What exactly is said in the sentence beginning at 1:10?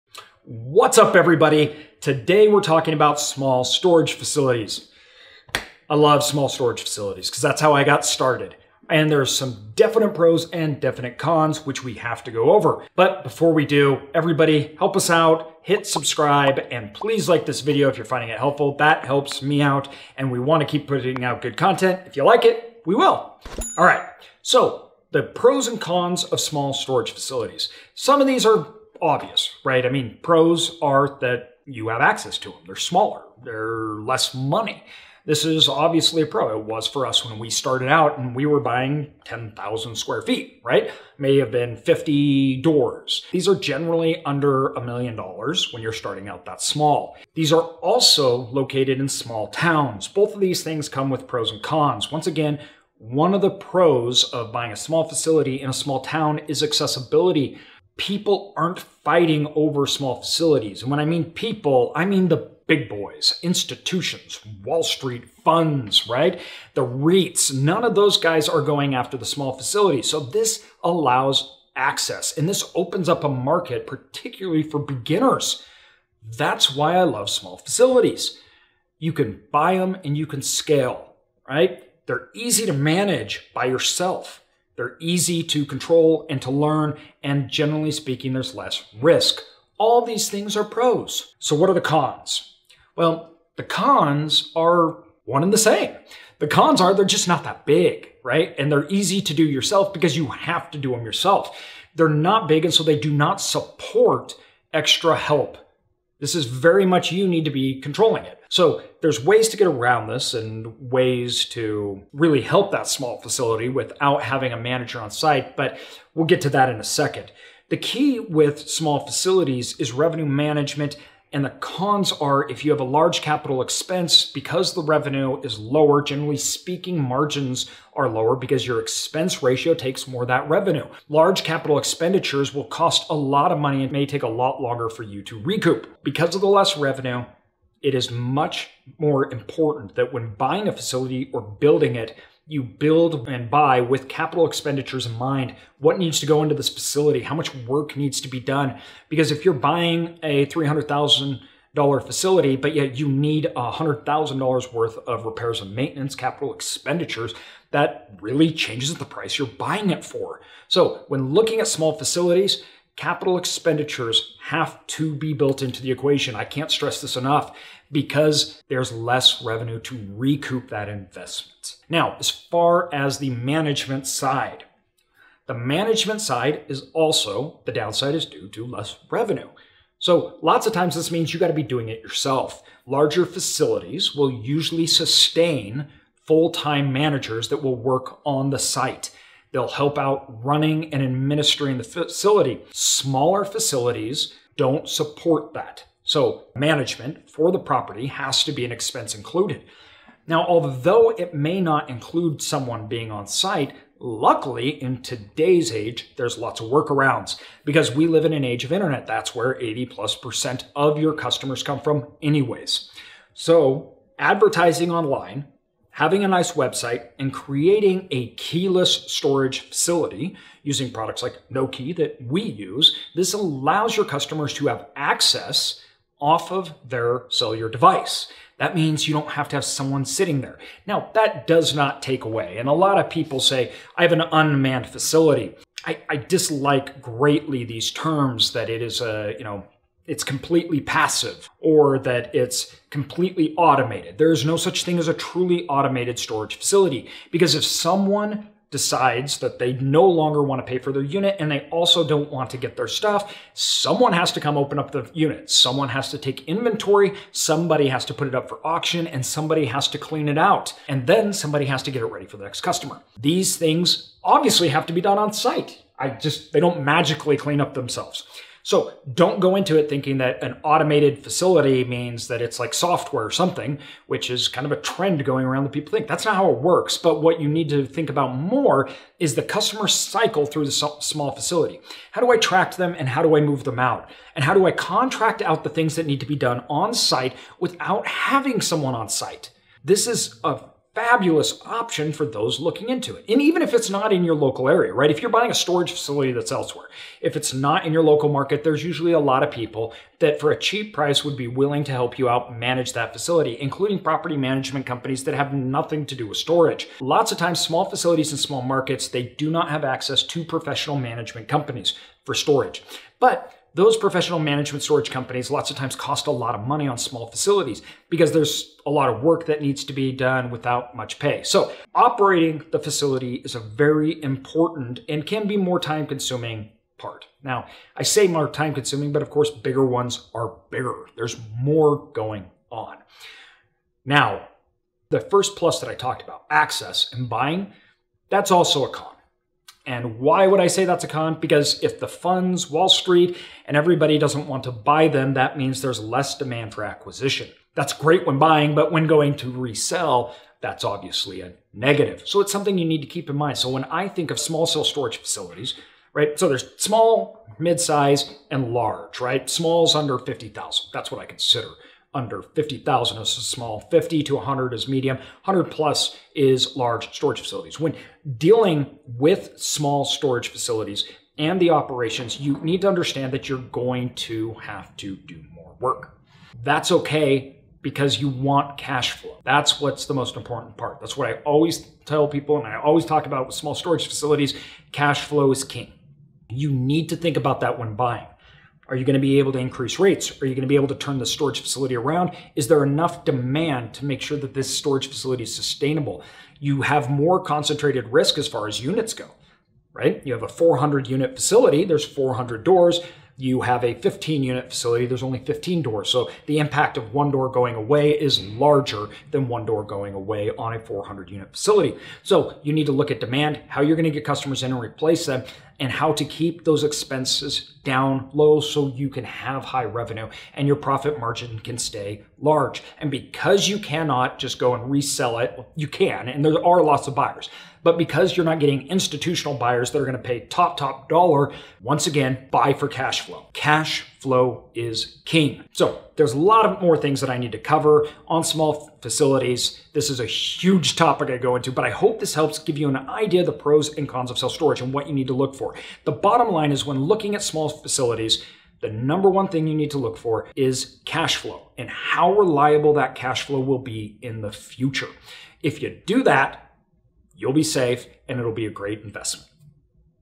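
So this allows access and this opens up a market, particularly for beginners.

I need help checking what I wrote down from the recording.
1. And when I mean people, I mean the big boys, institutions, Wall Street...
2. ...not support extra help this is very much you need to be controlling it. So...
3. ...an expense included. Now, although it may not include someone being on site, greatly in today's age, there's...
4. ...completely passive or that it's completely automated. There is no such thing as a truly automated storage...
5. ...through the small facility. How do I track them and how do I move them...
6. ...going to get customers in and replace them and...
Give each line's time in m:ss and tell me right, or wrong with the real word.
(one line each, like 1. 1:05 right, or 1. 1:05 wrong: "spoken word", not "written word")
1. 1:00 right
2. 1:43 right
3. 3:18 wrong: "luckily", not "greatly"
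4. 4:00 right
5. 4:40 right
6. 6:53 right.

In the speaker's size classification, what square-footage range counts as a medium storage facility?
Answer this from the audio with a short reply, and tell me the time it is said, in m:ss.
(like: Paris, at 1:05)
50,000 to 100,000, at 6:03.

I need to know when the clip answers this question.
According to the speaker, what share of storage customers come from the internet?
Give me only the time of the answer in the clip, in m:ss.
3:29.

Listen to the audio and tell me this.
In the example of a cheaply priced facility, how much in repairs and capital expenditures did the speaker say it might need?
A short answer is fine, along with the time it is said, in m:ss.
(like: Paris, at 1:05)
$100,000, at 2:33.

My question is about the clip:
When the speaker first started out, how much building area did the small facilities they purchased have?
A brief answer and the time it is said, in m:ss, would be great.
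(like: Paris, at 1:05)
10,000 square feet, at 0:39.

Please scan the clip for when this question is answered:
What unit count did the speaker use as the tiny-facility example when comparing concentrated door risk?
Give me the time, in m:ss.
6:43.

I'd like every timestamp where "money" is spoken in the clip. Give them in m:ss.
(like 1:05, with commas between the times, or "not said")
0:34, 2:13, 5:16.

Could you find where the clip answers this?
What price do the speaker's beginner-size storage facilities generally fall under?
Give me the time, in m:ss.
0:44.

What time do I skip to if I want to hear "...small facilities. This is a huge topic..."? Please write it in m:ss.
7:18.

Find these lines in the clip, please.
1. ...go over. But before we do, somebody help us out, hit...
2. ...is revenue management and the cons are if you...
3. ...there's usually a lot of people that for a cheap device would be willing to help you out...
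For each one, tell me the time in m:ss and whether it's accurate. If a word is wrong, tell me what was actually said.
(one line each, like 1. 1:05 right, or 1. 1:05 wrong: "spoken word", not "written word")
1. 0:12 wrong: "everybody", not "somebody"
2. 1:59 right
3. 4:58 wrong: "price", not "device".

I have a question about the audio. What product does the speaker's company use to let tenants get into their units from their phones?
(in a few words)
Noke.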